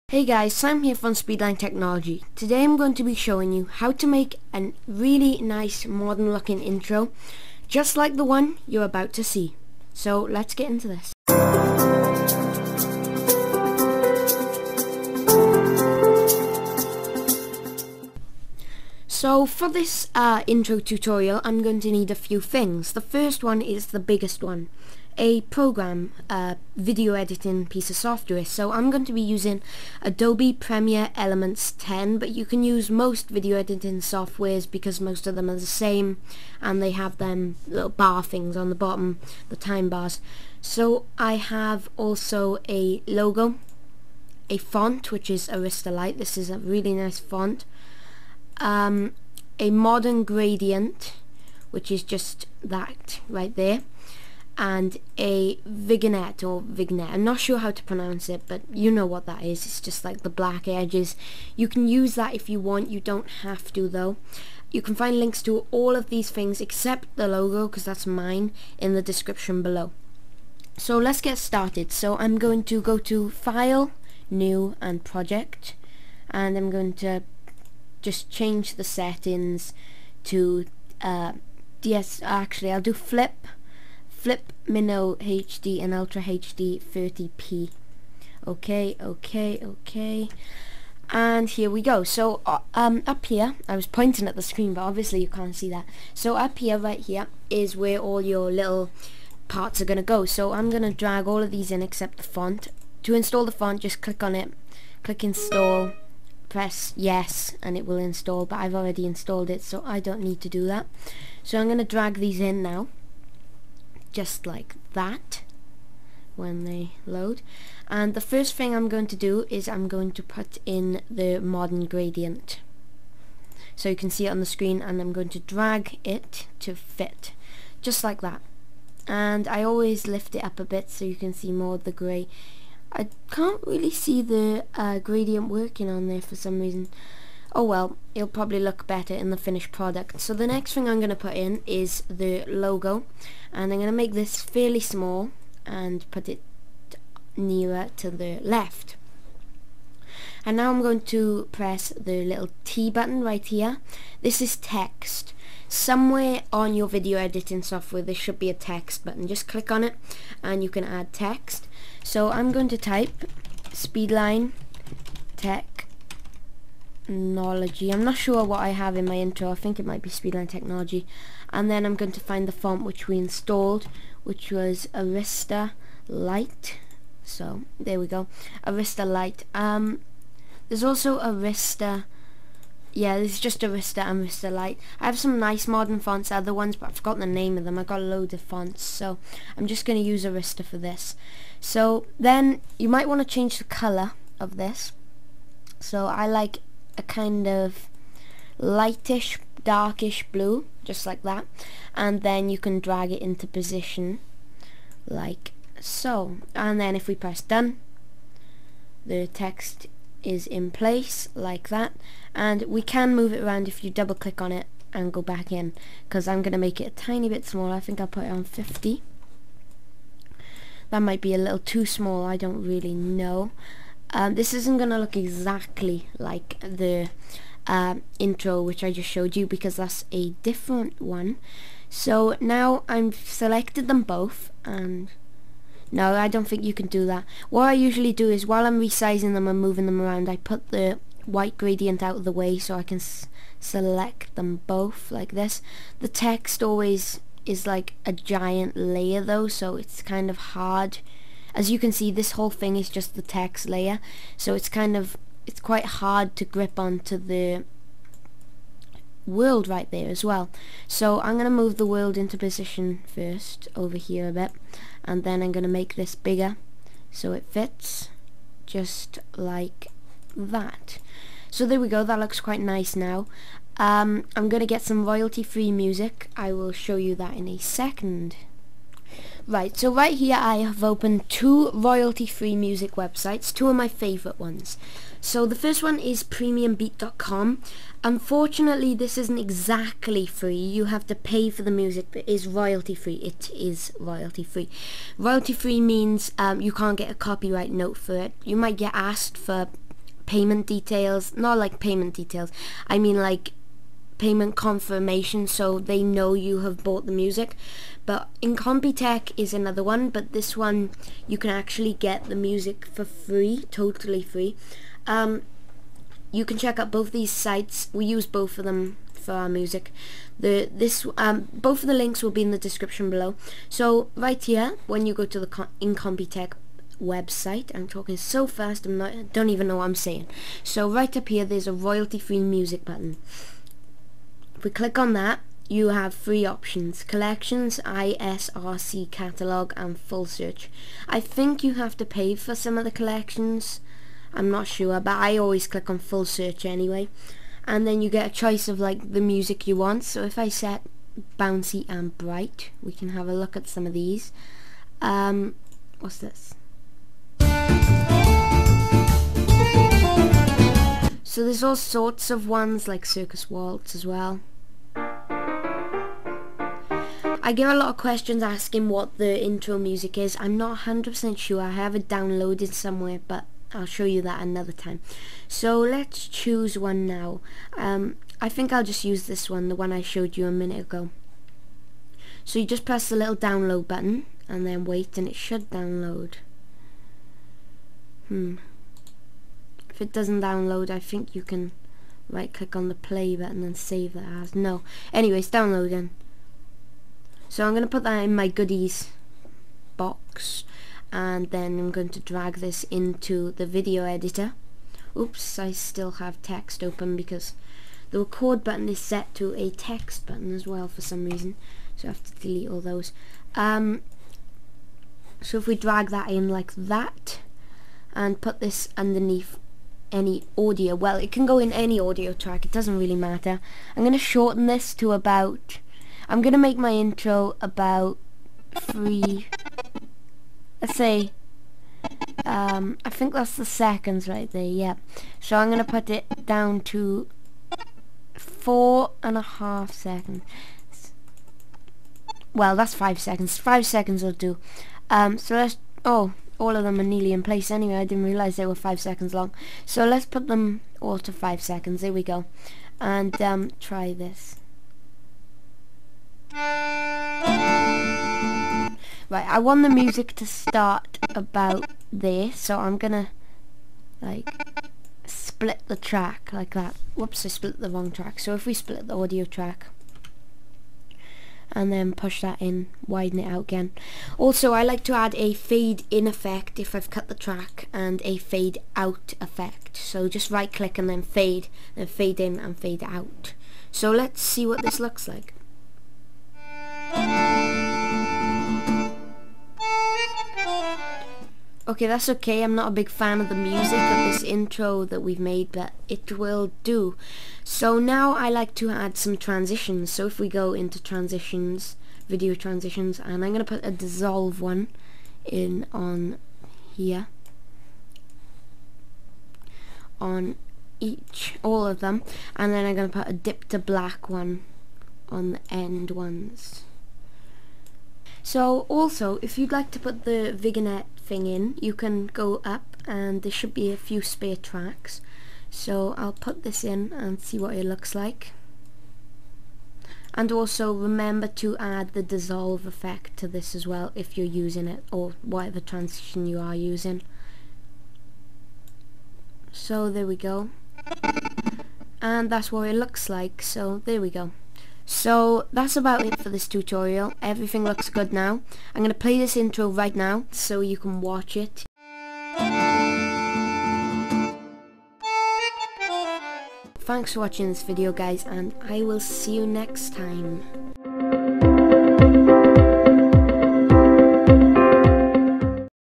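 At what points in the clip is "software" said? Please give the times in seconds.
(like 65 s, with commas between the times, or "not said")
27 s, 33 s, 157 s.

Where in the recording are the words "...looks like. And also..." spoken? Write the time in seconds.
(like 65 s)
527 s.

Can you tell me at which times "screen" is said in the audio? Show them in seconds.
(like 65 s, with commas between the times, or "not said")
94 s, 124 s.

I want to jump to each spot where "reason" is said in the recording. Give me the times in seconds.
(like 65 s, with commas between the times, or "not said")
136 s, 411 s.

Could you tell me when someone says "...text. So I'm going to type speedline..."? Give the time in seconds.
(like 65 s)
161 s.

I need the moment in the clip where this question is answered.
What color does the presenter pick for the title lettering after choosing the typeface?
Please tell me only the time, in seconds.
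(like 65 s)
198 s.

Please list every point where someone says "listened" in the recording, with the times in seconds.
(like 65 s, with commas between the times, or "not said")
not said.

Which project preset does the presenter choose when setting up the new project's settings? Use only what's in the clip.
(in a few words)
Flip Mino HD.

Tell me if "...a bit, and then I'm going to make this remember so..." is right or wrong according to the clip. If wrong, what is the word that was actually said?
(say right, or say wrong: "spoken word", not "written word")
wrong: "bigger", not "remember".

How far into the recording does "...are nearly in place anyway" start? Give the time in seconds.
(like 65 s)
446 s.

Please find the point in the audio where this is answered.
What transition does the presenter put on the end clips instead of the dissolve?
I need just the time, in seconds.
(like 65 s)
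513 s.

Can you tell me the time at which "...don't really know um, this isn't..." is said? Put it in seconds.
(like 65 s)
222 s.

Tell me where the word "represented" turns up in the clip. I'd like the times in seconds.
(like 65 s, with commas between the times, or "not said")
not said.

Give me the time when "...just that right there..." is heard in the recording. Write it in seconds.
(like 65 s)
52 s.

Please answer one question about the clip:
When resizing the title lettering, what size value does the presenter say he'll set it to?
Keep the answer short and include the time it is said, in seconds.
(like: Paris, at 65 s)
50, at 218 s.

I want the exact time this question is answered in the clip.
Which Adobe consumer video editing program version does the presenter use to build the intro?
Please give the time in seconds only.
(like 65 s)
30 s.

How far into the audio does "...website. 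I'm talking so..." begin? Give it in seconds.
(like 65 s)
327 s.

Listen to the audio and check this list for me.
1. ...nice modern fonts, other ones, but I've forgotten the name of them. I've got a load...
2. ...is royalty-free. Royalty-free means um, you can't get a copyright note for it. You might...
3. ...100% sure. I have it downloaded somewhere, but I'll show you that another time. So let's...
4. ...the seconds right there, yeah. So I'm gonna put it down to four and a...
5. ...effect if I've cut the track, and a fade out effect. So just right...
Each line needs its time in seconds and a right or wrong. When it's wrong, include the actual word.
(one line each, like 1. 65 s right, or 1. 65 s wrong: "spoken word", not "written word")
1. 185 s right
2. 293 s right
3. 370 s right
4. 433 s right
5. 476 s right.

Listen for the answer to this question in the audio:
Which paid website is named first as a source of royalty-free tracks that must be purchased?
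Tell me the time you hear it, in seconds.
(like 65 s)
286 s.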